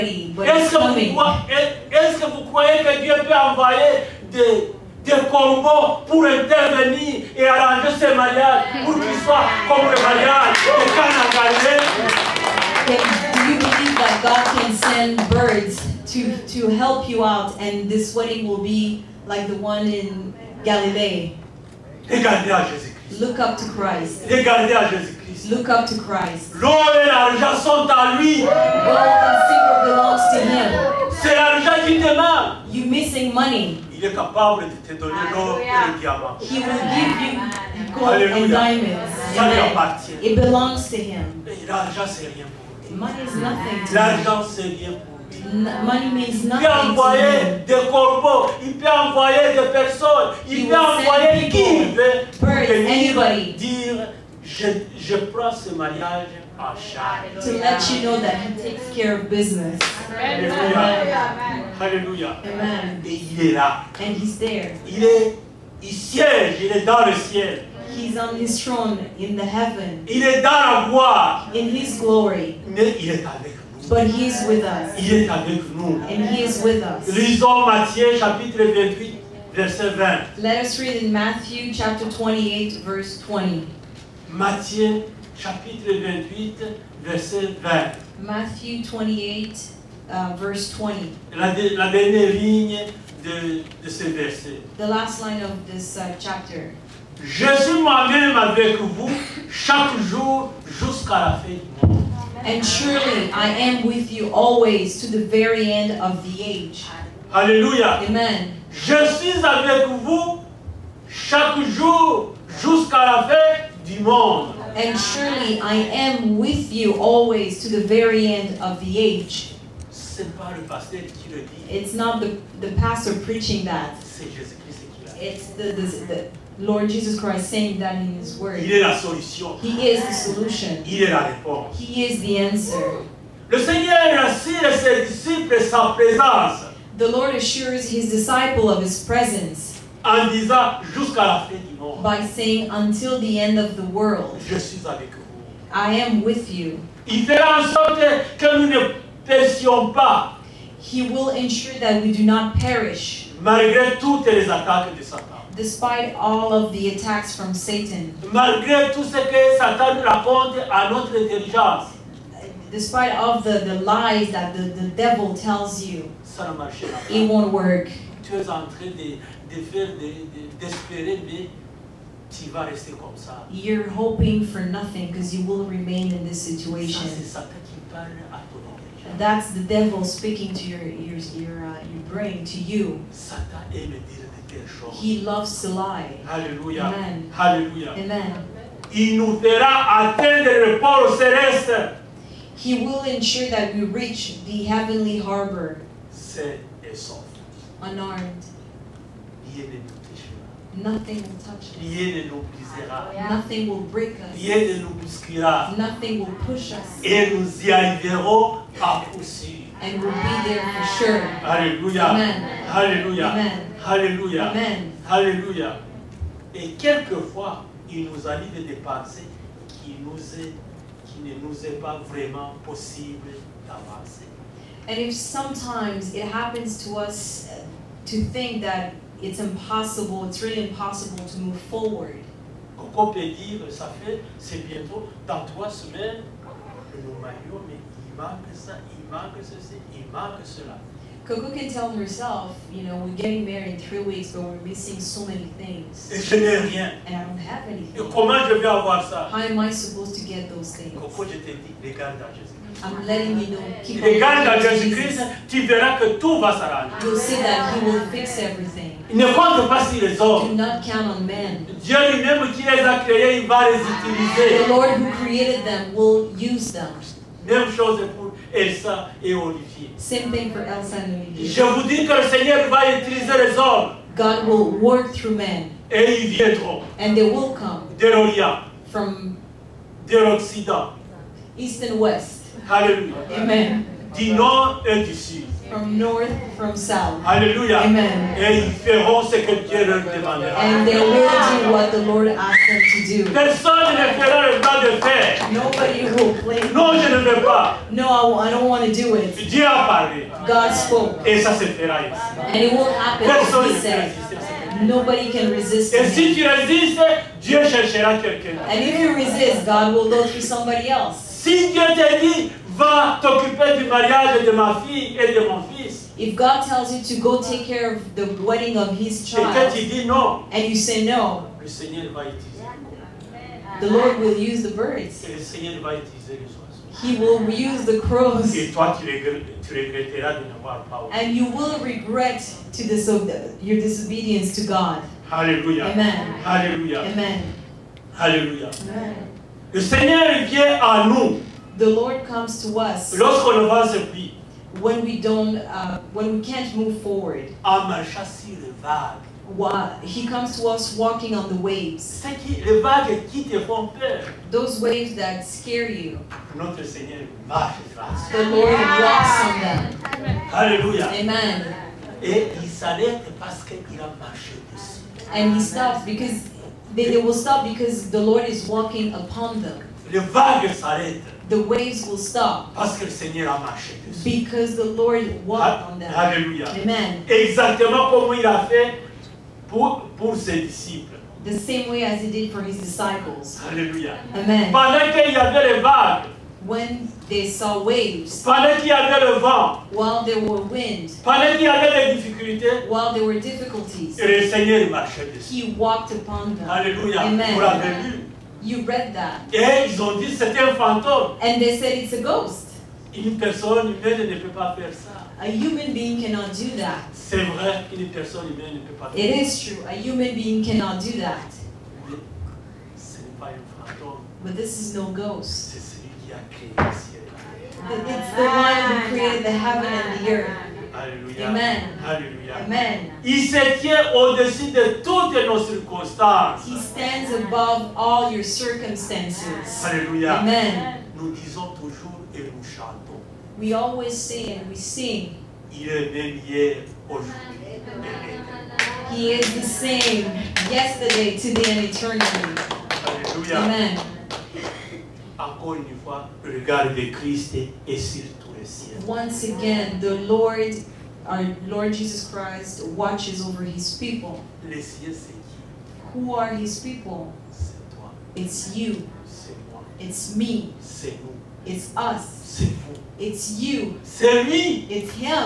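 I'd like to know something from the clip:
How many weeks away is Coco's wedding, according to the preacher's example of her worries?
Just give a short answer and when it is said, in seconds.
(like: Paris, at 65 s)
3, at 243 s.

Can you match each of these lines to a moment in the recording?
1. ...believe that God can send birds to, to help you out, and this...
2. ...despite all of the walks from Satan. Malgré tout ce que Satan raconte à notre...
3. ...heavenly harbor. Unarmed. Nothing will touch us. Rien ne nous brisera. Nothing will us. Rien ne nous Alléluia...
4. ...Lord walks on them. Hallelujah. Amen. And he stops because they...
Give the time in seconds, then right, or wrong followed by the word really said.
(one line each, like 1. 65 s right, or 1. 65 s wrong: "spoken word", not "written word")
1. 13 s right
2. 155 s wrong: "attacks", not "walks"
3. 194 s wrong: "Nothing", not "Alléluia"
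4. 358 s right.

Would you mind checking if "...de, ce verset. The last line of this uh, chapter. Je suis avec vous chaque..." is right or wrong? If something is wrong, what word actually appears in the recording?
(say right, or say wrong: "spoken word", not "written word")
right.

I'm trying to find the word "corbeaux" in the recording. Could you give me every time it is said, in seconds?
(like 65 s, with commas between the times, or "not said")
5 s, 47 s.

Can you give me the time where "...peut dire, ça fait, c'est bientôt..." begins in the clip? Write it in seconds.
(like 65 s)
233 s.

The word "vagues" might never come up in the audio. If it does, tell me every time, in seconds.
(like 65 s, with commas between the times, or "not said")
370 s, 385 s.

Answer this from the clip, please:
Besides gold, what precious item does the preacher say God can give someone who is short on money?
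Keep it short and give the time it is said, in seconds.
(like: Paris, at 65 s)
diamonds, at 38 s.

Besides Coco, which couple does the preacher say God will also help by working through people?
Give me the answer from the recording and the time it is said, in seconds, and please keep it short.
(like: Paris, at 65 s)
Elsa and Olivier, at 270 s.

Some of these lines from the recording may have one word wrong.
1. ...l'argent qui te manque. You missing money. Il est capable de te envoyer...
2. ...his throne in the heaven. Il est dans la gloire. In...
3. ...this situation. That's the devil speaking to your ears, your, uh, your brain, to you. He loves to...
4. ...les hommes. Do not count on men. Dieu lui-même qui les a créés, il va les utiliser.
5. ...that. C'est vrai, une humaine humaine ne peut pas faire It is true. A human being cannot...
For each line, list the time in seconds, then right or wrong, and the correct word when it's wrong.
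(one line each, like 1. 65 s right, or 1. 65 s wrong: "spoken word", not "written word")
1. 31 s wrong: "donner", not "envoyer"
2. 68 s right
3. 176 s right
4. 260 s right
5. 406 s wrong: "personne", not "humaine".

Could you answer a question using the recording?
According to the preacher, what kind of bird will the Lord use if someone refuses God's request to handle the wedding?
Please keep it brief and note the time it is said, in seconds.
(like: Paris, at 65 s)
crows, at 328 s.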